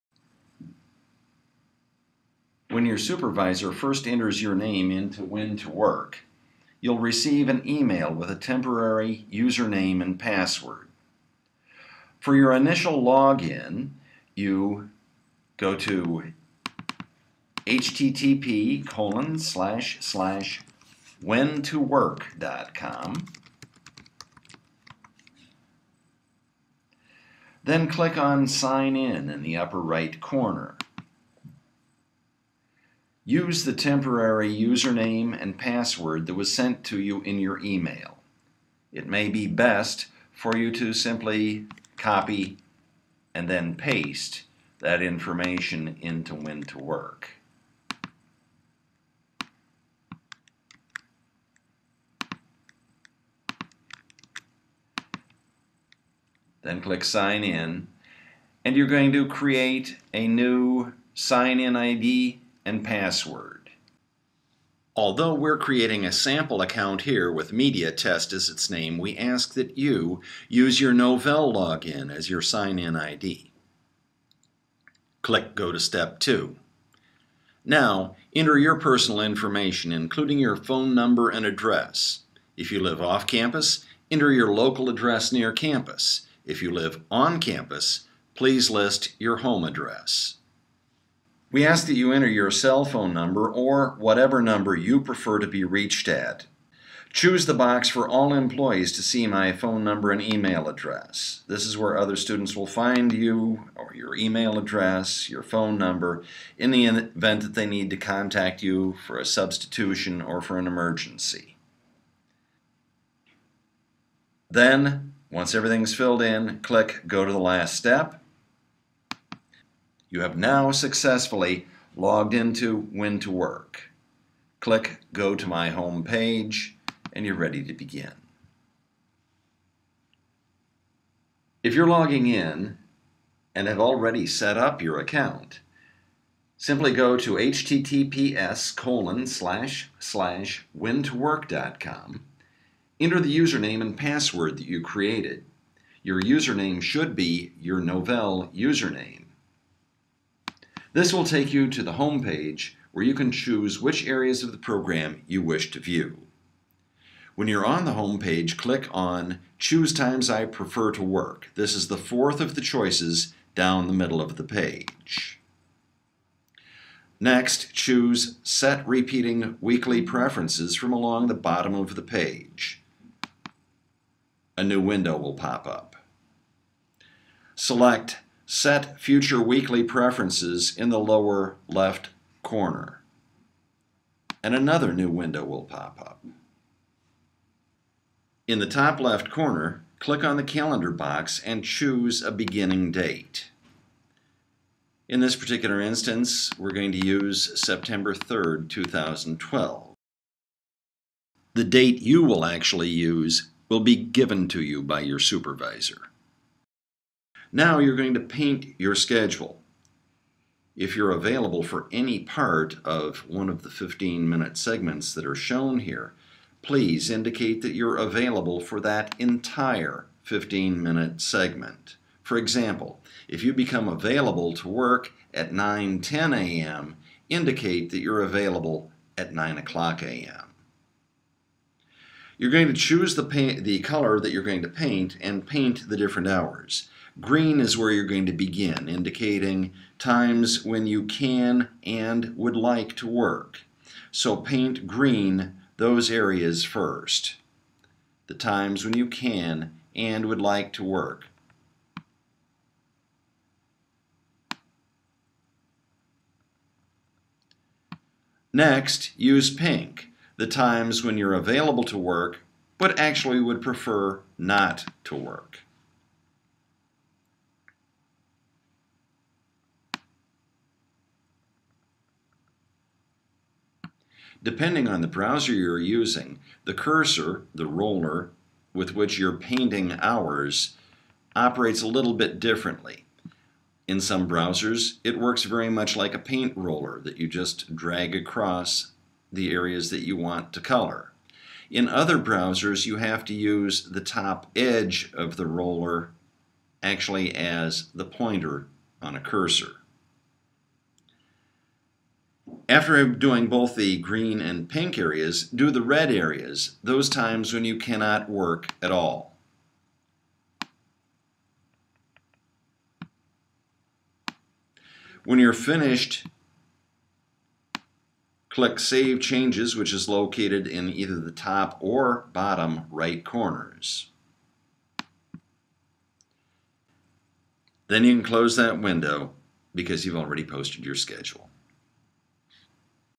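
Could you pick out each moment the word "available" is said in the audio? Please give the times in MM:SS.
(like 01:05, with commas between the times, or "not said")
03:31, 03:37, 03:43, 03:48, 04:21.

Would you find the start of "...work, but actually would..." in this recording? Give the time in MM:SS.
04:21.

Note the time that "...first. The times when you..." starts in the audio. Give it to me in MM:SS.
04:06.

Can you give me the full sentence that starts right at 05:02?
After doing both the green and pink areas, do the red areas, those times when you cannot work at all.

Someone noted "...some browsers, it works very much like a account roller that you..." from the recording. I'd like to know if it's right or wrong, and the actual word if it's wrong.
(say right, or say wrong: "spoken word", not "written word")
wrong: "paint", not "account".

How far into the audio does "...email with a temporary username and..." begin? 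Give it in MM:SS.
00:07.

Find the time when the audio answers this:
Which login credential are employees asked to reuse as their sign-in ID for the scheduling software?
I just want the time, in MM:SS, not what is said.
01:10.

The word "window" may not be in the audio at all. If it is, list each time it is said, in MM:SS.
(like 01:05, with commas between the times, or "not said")
02:54, 03:05, 05:28.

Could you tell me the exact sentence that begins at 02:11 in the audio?
If you're logging in and have already set up your account, simply go to https colon slash slash whentowork.com.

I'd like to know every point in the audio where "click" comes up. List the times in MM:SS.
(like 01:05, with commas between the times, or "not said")
00:27, 00:56, 01:15, 01:56, 02:04, 02:38, 03:09, 05:18.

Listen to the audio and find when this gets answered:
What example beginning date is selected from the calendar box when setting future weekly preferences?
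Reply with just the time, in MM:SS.
03:17.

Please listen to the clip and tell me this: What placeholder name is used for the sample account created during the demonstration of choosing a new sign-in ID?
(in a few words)
MediaTest.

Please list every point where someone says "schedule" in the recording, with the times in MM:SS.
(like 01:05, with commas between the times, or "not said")
03:28, 05:30.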